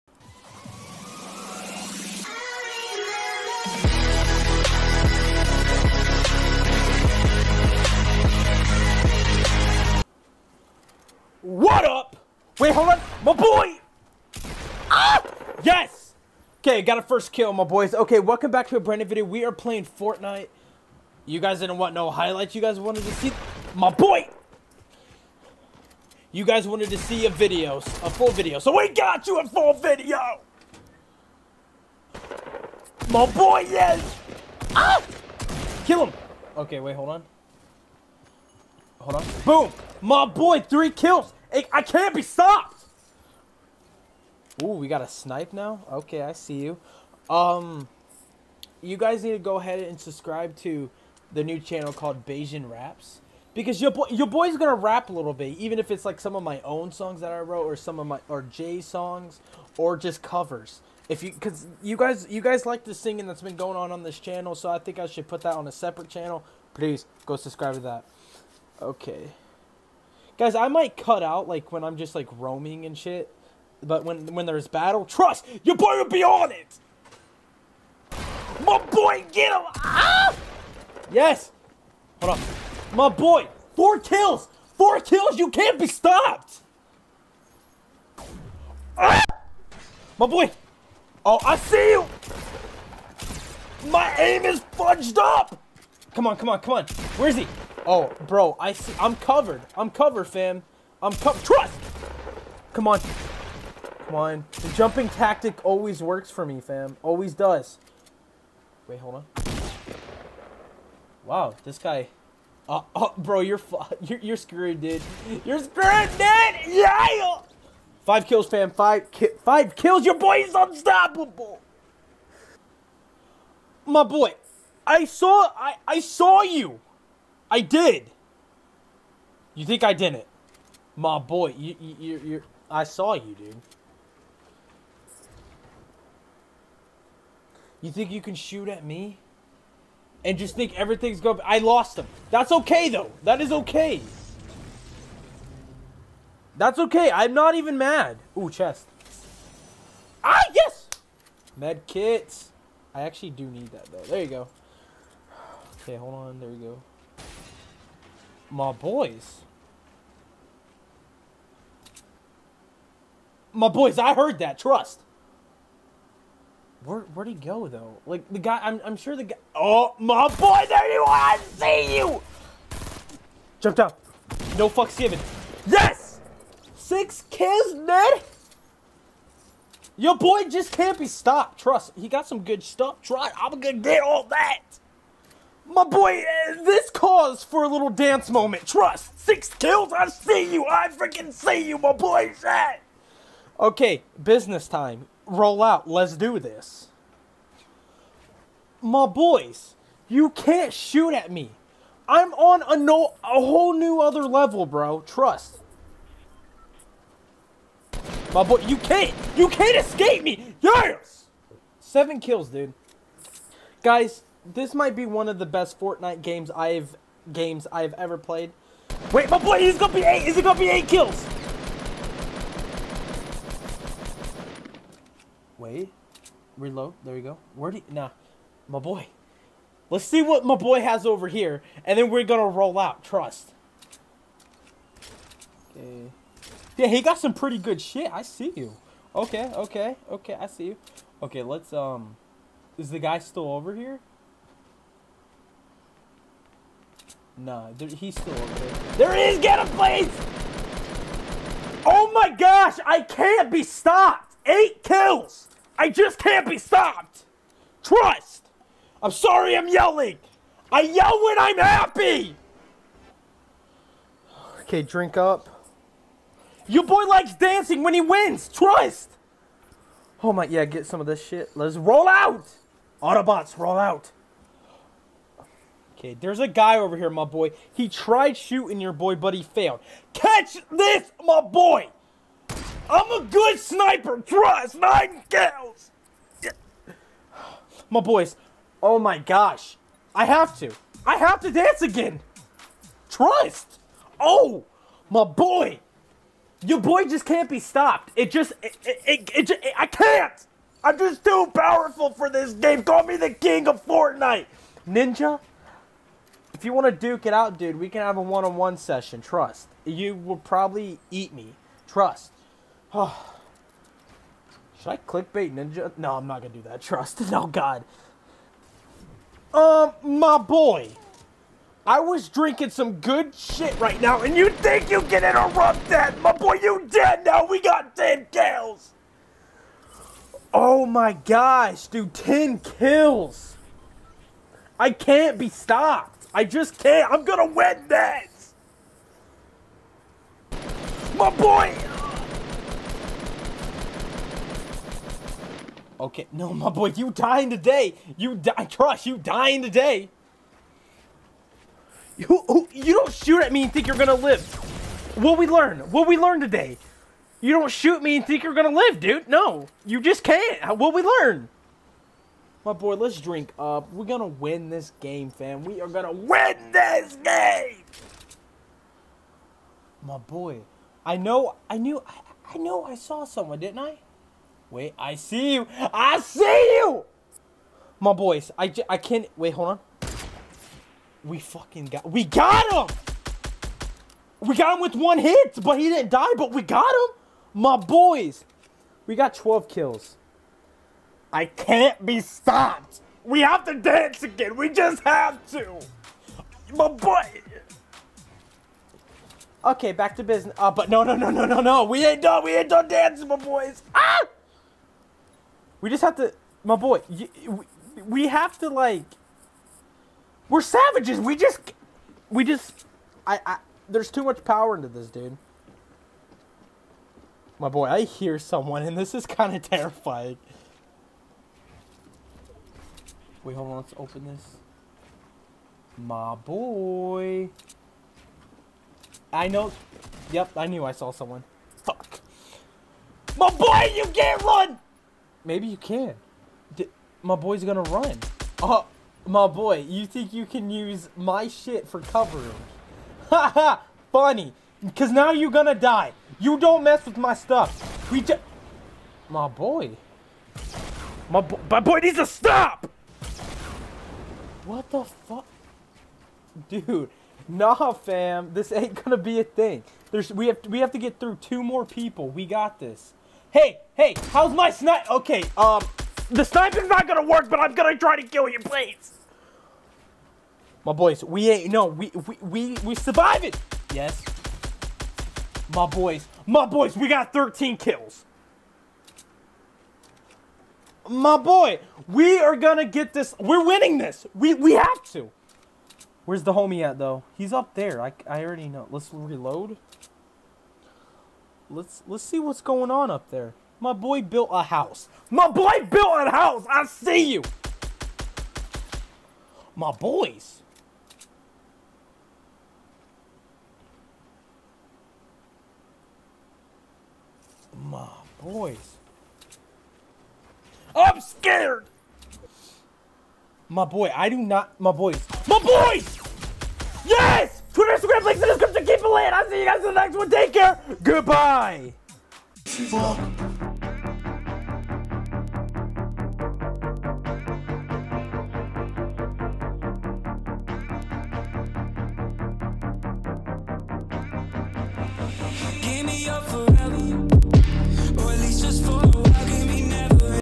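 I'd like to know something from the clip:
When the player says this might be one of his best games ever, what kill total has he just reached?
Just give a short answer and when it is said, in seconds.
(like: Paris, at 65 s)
7, at 211 s.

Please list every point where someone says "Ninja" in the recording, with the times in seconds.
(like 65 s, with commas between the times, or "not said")
304 s, 315 s.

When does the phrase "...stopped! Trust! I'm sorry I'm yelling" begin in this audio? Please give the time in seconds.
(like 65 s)
256 s.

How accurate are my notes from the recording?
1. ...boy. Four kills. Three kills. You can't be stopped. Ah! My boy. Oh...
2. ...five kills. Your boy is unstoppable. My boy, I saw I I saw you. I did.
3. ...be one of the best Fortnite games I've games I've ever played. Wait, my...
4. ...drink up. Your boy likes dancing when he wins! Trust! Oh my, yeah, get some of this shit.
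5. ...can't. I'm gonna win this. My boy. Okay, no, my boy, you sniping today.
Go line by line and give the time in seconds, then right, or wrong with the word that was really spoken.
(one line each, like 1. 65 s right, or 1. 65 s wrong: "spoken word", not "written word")
1. 83 s wrong: "Four", not "Three"
2. 119 s right
3. 214 s right
4. 264 s right
5. 336 s wrong: "dying", not "sniping".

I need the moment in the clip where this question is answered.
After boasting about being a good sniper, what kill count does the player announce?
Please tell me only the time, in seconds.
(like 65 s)
284 s.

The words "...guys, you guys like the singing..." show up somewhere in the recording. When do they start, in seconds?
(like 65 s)
61 s.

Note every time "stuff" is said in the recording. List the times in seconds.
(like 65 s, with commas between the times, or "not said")
182 s, 447 s.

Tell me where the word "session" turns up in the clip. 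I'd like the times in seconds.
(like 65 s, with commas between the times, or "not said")
308 s.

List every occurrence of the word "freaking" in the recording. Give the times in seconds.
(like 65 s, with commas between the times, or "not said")
190 s.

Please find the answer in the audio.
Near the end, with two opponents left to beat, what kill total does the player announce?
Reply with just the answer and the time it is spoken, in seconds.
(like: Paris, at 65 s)
13, at 477 s.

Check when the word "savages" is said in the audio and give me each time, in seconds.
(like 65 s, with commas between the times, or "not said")
410 s.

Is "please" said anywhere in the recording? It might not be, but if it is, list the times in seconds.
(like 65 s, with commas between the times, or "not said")
66 s, 249 s, 468 s.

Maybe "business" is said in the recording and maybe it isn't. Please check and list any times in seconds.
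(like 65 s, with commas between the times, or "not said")
194 s, 400 s.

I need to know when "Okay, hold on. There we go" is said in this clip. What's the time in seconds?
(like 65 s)
155 s.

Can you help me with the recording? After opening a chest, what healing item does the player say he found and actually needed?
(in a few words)
Med kits.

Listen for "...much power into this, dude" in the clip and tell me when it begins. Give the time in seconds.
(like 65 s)
414 s.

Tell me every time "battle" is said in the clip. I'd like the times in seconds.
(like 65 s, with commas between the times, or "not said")
74 s.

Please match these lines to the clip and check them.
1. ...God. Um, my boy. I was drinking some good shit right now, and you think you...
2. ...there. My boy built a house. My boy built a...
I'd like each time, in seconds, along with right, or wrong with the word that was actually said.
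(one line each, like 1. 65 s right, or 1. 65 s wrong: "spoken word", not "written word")
1. 317 s right
2. 493 s right.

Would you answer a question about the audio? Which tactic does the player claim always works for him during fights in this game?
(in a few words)
Jumping tactic.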